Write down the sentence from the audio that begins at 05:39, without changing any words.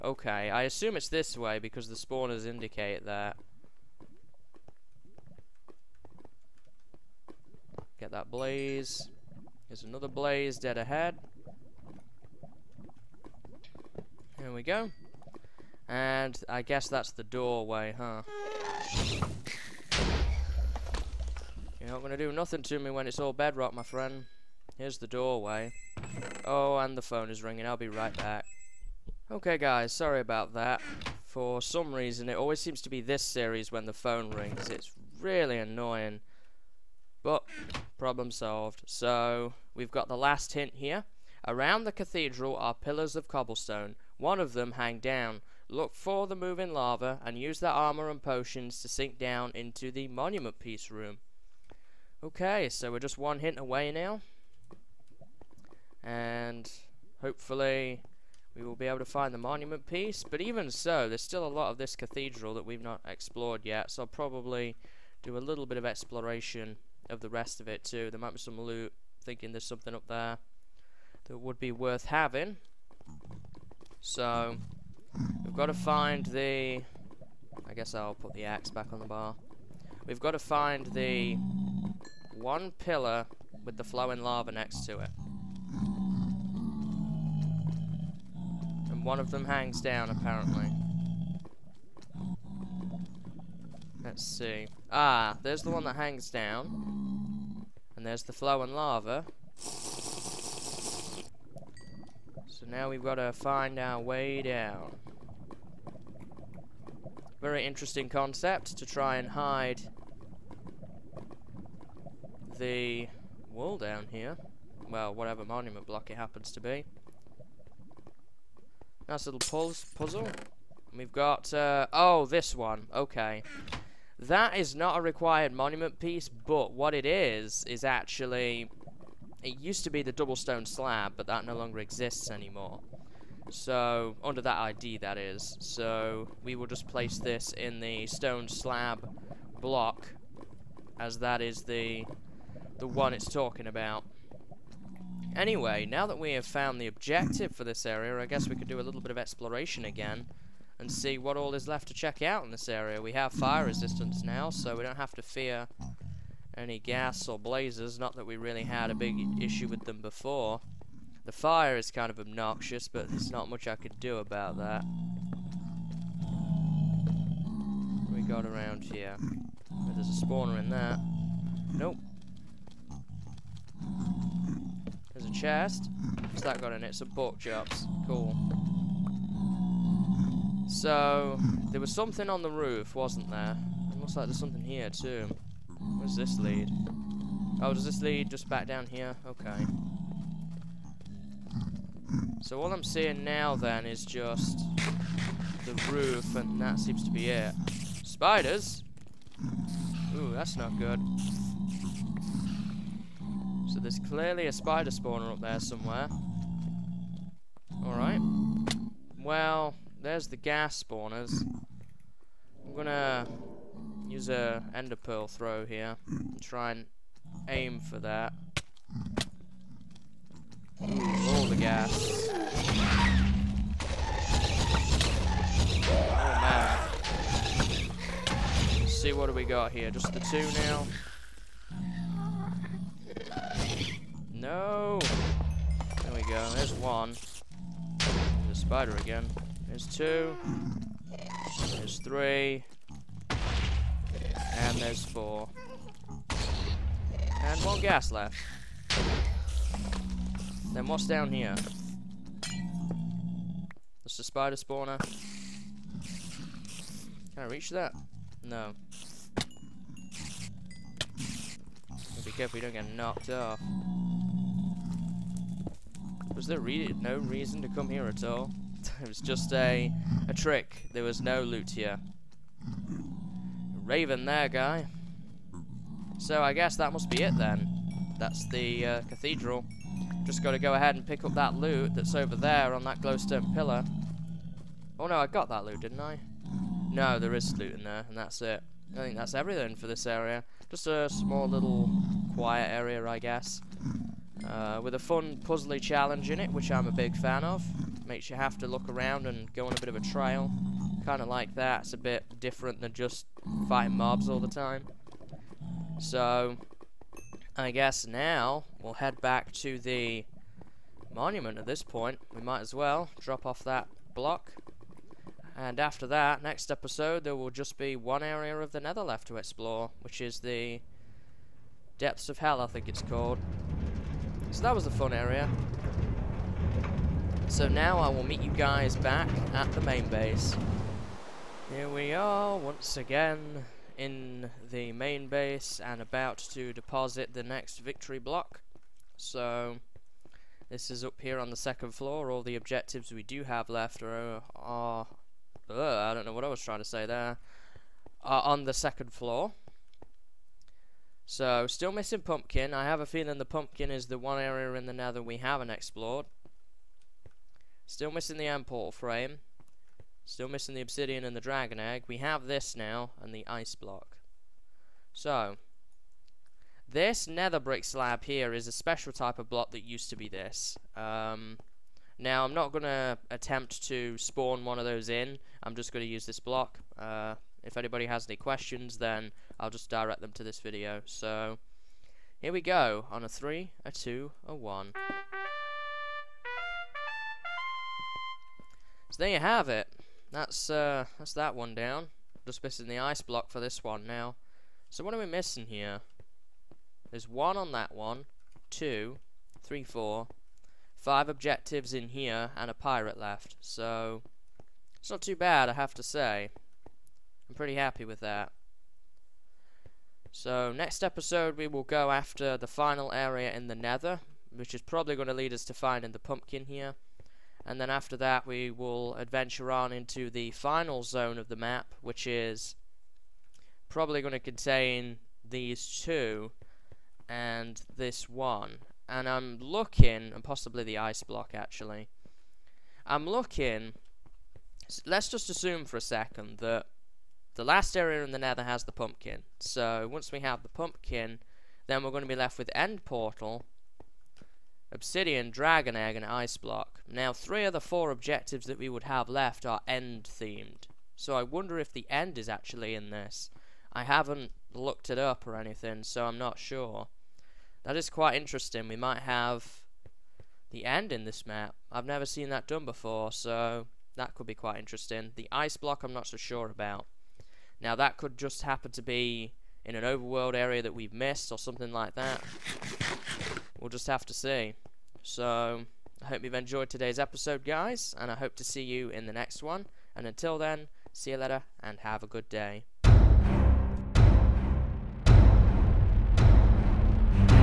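So this is up here on the second floor.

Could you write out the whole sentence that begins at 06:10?
Um, now, I'm not going to attempt to spawn one of those in.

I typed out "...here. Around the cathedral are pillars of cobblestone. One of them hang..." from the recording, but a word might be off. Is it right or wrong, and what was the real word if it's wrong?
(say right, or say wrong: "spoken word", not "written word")
right.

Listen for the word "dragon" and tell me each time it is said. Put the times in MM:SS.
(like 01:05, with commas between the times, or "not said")
06:01, 07:25.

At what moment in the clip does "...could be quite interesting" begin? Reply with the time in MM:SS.
07:44.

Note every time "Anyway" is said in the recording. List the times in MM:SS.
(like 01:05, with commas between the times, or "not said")
02:25.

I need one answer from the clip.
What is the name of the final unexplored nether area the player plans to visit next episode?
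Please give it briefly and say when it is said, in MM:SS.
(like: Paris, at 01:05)
Depths of Hell, at 05:21.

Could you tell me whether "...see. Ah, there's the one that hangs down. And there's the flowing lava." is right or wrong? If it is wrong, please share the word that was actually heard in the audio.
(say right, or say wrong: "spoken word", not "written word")
right.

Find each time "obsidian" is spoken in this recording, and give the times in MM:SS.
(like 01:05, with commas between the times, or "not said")
06:00, 07:24.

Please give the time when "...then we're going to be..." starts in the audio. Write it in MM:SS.
07:21.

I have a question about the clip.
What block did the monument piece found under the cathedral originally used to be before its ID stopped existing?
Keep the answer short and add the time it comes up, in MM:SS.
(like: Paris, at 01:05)
Double stone slab, at 02:10.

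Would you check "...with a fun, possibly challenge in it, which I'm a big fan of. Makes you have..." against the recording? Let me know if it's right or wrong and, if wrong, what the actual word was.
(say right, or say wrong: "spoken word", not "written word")
wrong: "puzzly", not "possibly".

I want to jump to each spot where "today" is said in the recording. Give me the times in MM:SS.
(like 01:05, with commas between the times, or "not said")
07:56.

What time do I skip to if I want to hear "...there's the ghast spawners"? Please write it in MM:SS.
03:30.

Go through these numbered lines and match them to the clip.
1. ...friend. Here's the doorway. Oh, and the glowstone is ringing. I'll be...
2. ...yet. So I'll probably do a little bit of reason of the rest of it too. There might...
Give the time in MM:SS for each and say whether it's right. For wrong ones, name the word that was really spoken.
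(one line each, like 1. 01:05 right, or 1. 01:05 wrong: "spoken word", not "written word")
1. 00:23 wrong: "phone", not "glowstone"
2. 01:03 wrong: "exploration", not "reason".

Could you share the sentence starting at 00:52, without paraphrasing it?
Okay, so we're just one hint away now.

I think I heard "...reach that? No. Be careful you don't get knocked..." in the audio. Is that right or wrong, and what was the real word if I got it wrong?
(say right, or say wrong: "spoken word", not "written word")
right.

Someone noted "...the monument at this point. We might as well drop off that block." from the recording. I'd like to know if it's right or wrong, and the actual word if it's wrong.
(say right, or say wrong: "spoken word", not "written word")
right.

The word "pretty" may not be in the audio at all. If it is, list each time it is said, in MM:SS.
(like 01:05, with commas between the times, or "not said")
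06:47.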